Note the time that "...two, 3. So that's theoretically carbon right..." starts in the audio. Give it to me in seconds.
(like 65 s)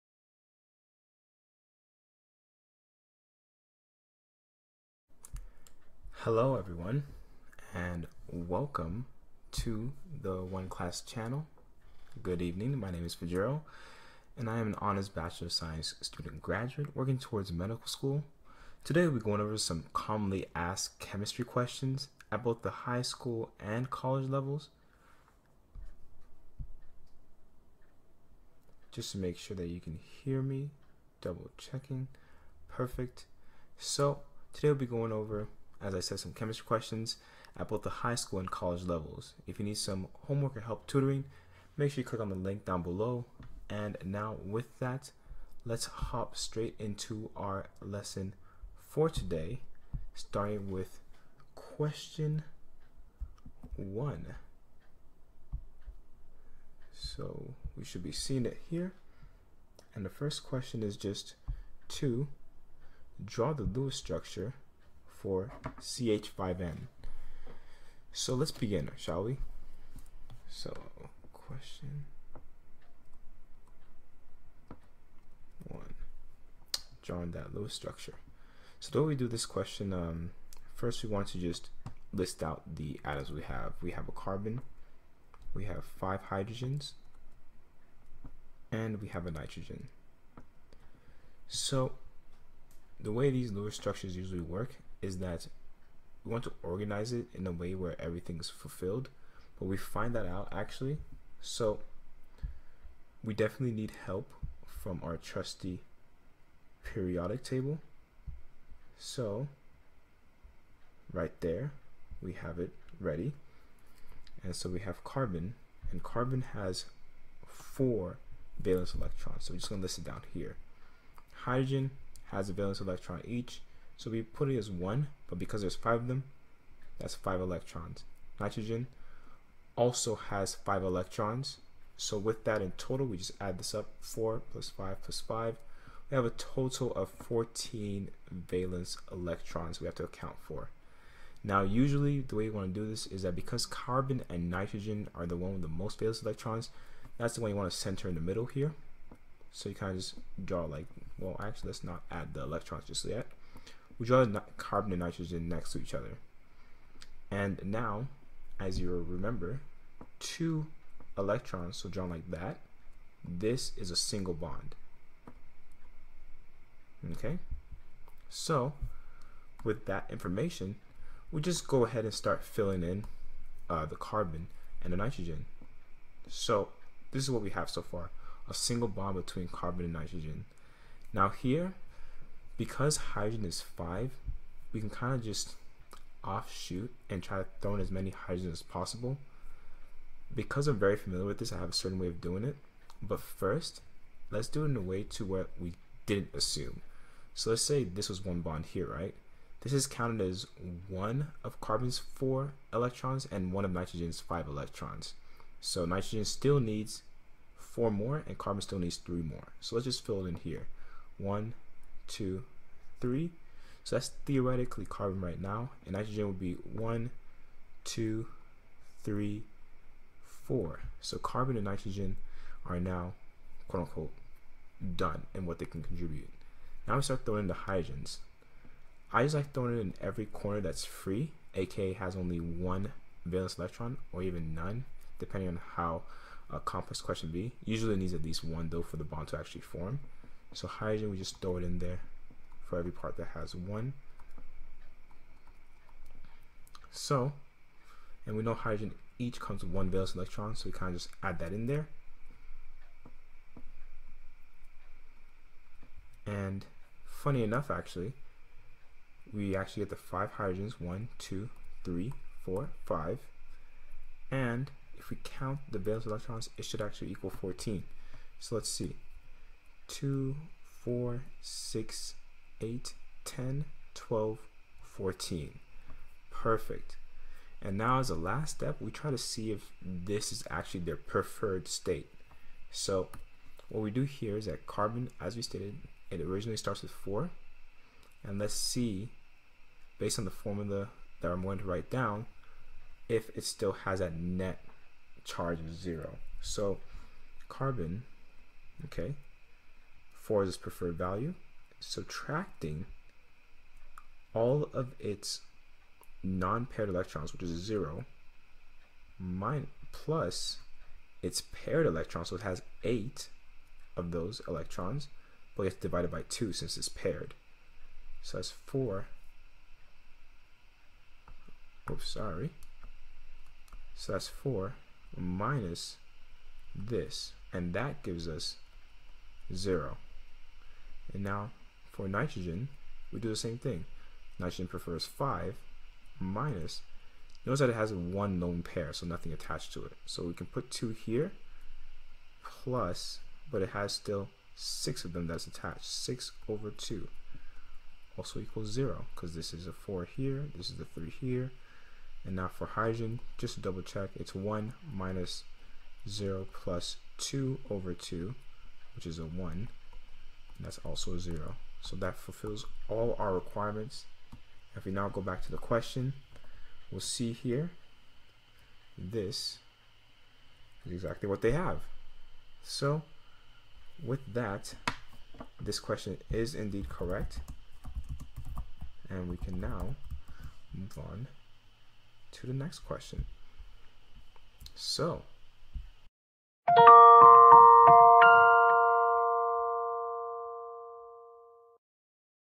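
212 s.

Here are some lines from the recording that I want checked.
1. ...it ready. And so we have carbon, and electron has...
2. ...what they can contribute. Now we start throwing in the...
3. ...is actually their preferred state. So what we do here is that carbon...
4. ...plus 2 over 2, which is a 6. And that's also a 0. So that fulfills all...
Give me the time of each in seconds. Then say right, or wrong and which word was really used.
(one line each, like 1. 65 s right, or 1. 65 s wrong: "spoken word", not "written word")
1. 112 s wrong: "carbon", not "electron"
2. 225 s right
3. 280 s right
4. 356 s wrong: "1", not "6".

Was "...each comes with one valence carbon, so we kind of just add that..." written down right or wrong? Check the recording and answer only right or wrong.
wrong.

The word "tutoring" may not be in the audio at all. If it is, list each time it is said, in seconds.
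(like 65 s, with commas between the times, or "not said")
40 s.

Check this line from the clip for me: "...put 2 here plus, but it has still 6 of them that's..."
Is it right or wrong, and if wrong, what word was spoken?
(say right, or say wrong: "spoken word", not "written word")
right.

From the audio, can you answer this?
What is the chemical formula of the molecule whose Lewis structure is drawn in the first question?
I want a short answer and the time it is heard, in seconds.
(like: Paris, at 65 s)
CH5N, at 65 s.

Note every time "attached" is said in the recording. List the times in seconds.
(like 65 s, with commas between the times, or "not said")
339 s, 345 s.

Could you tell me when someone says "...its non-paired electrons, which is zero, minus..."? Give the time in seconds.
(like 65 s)
304 s.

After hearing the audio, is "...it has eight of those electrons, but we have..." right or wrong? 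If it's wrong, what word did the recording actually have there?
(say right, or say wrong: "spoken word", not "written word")
right.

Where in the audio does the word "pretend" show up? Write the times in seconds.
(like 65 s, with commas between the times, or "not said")
not said.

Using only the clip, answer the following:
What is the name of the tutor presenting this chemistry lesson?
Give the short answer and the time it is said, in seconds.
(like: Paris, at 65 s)
Fajero, at 13 s.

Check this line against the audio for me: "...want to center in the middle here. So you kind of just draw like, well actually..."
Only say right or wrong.
right.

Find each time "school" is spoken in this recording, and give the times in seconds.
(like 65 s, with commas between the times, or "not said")
17 s, 23 s, 38 s.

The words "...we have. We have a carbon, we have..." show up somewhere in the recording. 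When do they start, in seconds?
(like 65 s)
83 s.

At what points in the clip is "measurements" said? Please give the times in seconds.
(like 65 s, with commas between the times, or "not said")
not said.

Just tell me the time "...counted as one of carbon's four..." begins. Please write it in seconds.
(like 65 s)
199 s.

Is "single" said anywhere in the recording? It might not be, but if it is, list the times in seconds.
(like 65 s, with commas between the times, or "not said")
163 s, 178 s.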